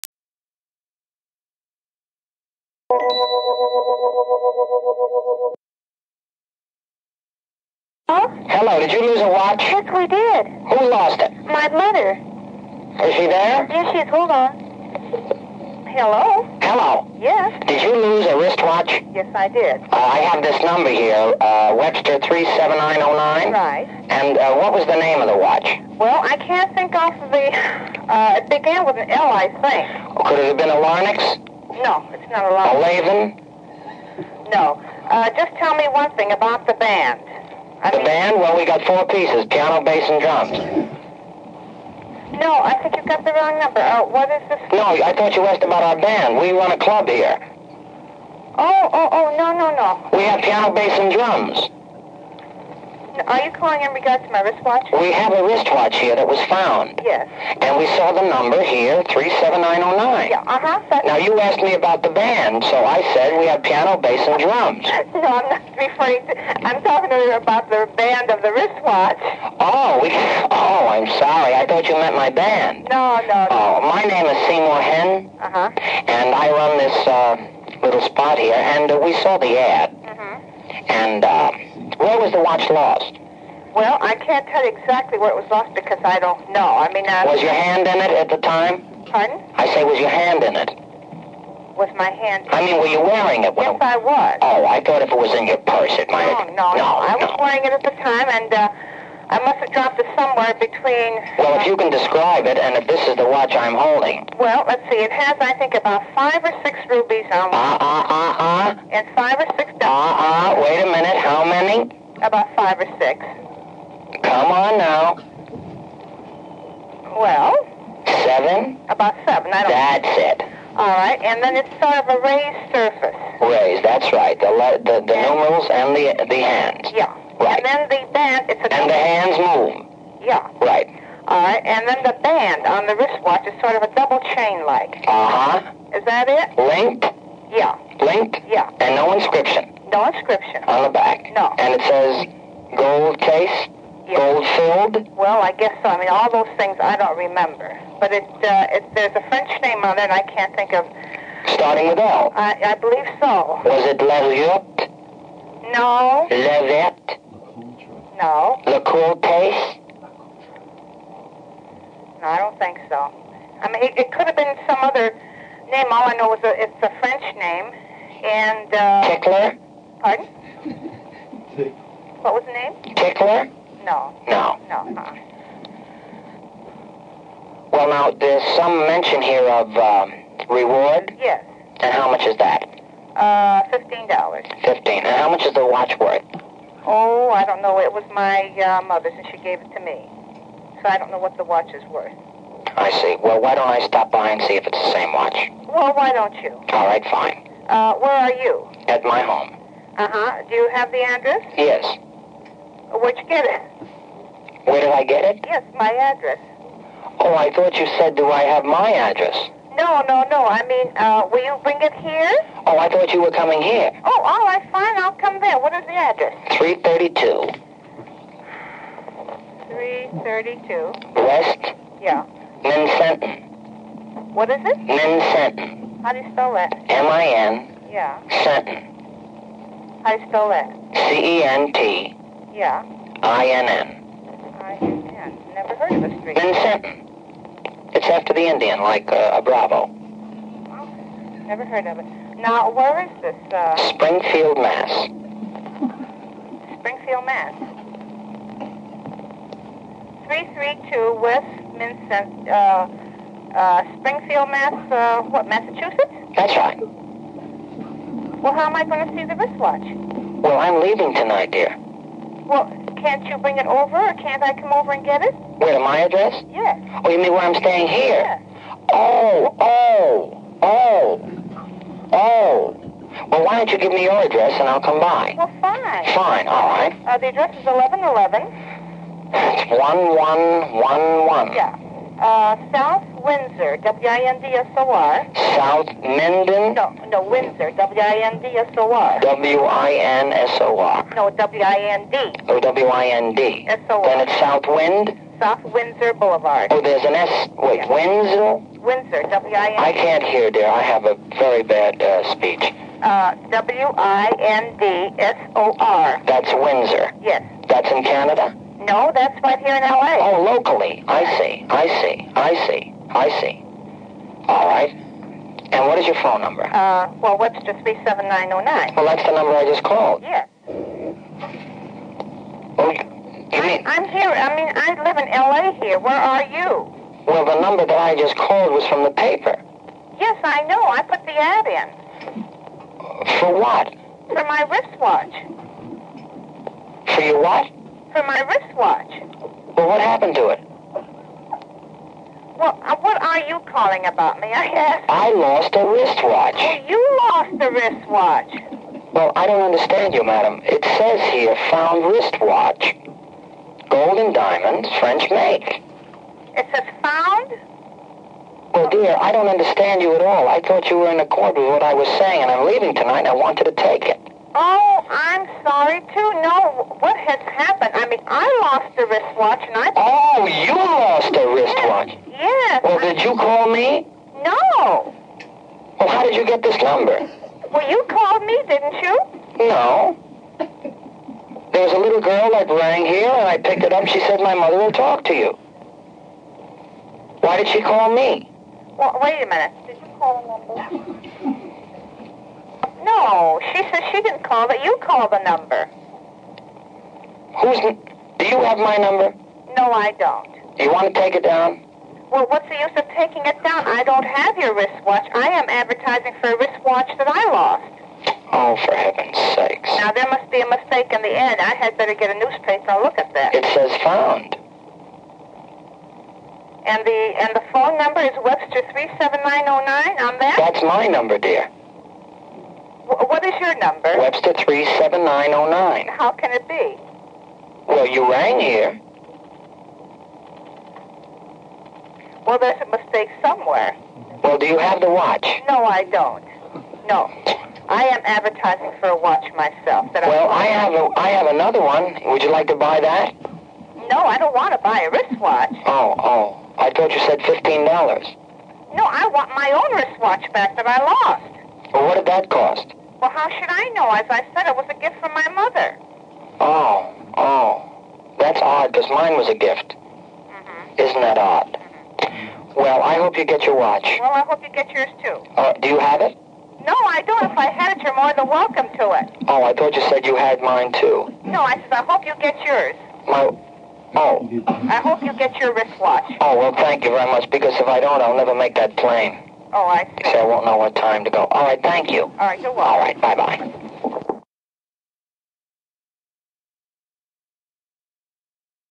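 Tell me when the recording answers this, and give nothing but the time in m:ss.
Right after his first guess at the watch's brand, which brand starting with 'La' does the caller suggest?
0:32.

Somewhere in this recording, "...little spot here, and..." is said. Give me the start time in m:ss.
1:17.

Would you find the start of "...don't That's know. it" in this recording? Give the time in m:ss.
1:59.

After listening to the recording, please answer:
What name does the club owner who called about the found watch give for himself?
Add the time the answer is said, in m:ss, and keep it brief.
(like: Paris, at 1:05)
Seymour Hen, at 1:14.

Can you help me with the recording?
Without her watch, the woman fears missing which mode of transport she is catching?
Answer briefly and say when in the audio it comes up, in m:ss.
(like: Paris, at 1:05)
plane, at 7:58.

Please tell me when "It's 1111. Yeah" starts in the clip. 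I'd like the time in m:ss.
4:39.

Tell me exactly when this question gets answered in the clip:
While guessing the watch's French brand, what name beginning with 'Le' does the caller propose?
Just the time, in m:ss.
2:36.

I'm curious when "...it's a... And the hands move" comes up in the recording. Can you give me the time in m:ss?
2:08.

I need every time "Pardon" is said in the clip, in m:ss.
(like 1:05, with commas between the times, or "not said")
1:29, 2:50.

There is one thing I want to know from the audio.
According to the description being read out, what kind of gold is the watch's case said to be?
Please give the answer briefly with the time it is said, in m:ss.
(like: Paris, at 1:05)
gold filled, at 2:24.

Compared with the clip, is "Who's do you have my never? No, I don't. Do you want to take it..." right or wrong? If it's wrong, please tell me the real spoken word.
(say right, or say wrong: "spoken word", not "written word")
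wrong: "number", not "never".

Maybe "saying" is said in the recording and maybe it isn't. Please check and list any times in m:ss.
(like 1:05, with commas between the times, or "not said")
6:02.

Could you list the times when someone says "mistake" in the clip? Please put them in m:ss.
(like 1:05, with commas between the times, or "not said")
6:50, 7:12.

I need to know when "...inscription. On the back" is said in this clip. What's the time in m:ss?
2:20.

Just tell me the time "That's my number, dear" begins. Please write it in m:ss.
7:00.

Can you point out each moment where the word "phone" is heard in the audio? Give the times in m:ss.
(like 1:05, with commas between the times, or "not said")
5:16, 6:57.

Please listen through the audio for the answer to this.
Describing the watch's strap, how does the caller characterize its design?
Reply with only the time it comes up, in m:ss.
2:13.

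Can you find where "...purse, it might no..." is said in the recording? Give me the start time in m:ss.
1:35.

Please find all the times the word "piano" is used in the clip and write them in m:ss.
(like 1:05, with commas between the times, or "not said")
0:39, 0:50, 1:03.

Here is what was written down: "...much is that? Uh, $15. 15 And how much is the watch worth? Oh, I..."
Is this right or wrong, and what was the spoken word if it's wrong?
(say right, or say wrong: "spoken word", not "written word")
right.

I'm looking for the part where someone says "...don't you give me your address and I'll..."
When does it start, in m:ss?
4:33.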